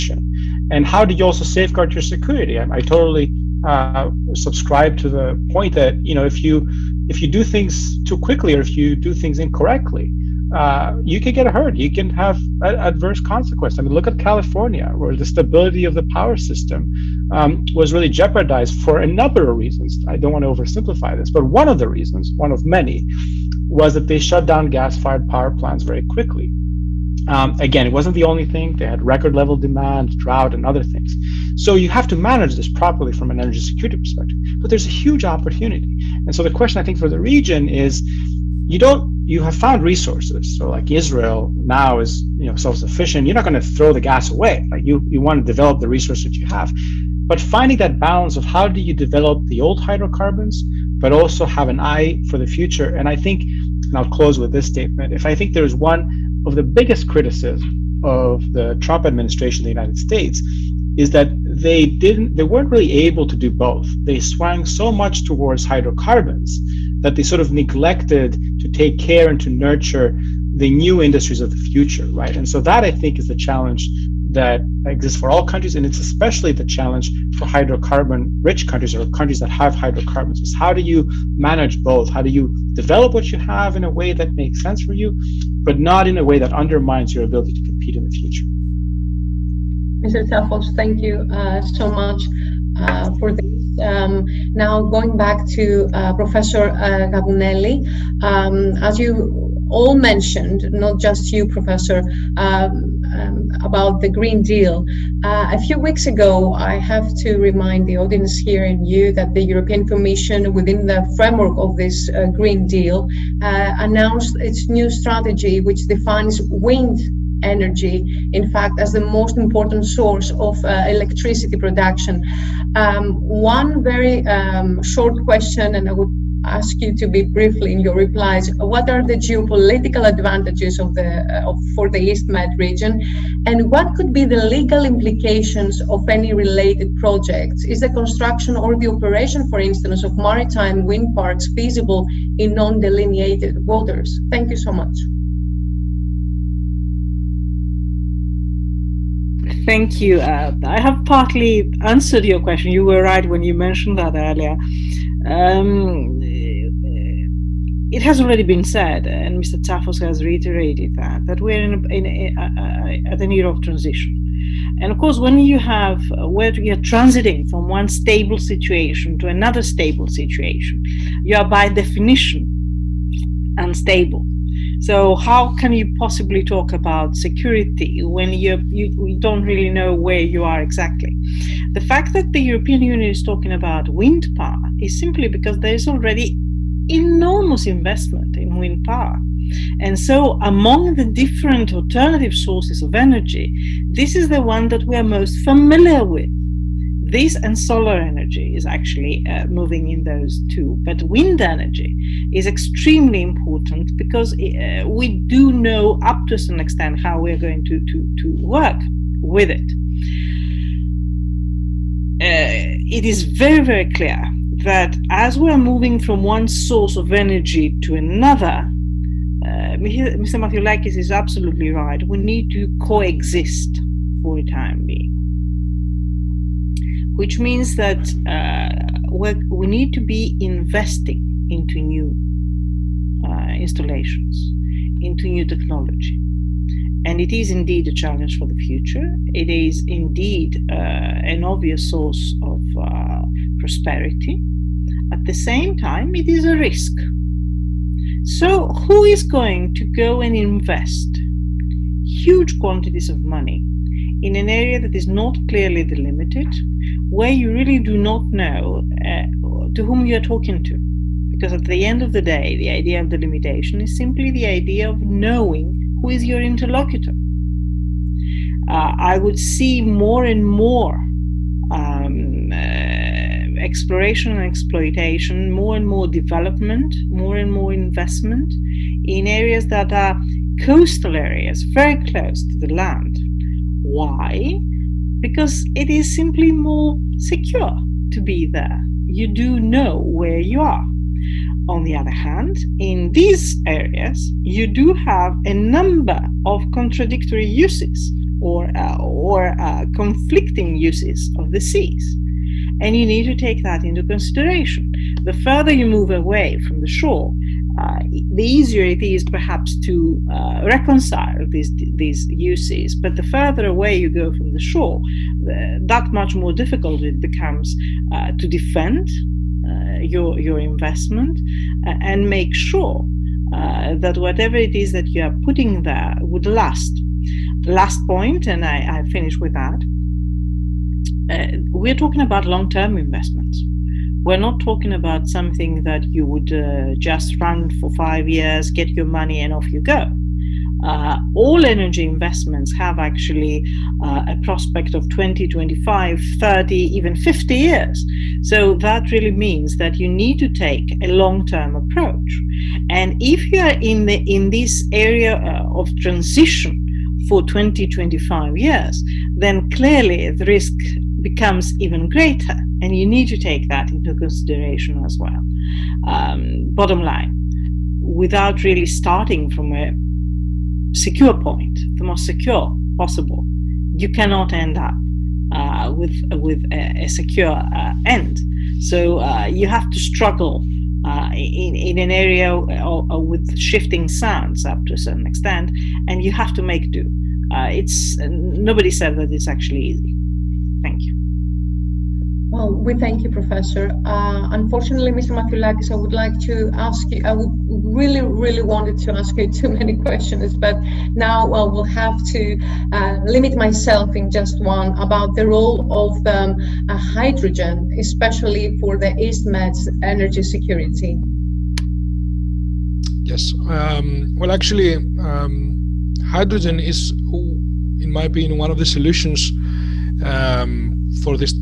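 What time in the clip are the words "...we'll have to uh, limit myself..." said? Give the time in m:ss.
6:41.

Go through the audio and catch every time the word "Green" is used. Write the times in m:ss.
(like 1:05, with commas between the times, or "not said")
1:44, 1:52.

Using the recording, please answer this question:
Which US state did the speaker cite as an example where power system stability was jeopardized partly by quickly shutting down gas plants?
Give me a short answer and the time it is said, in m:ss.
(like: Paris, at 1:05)
California, at 0:14.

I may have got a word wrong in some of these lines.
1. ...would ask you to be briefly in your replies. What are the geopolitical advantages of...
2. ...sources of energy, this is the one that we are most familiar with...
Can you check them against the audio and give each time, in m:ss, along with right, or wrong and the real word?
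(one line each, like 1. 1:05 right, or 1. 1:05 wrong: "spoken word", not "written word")
1. 2:05 right
2. 3:12 right.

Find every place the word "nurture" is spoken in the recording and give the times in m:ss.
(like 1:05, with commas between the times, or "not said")
1:09.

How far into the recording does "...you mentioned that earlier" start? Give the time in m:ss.
2:33.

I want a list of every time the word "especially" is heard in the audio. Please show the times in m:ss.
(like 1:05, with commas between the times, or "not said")
1:15, 6:47.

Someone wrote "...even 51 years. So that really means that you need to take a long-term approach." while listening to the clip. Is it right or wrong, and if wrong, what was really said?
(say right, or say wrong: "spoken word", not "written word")
wrong: "50", not "51".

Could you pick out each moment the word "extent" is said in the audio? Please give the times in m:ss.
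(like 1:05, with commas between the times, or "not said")
3:26, 6:25.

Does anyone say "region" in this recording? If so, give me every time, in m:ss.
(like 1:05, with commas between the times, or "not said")
0:37, 2:12.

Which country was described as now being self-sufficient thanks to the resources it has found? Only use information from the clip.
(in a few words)
Israel.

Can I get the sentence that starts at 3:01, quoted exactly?
The fact that the European Union is talking about wind power is simply because there is already enormous investment in wind power.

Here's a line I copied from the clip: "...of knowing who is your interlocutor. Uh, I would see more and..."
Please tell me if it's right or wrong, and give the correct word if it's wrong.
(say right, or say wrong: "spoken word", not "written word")
right.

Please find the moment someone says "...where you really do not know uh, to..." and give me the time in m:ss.
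4:17.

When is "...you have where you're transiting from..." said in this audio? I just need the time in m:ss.
2:45.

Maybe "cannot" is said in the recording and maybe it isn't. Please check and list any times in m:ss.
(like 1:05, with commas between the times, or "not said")
6:14.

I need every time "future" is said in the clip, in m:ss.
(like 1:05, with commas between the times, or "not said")
0:52, 1:11, 1:28, 3:58.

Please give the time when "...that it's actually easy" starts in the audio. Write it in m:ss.
6:29.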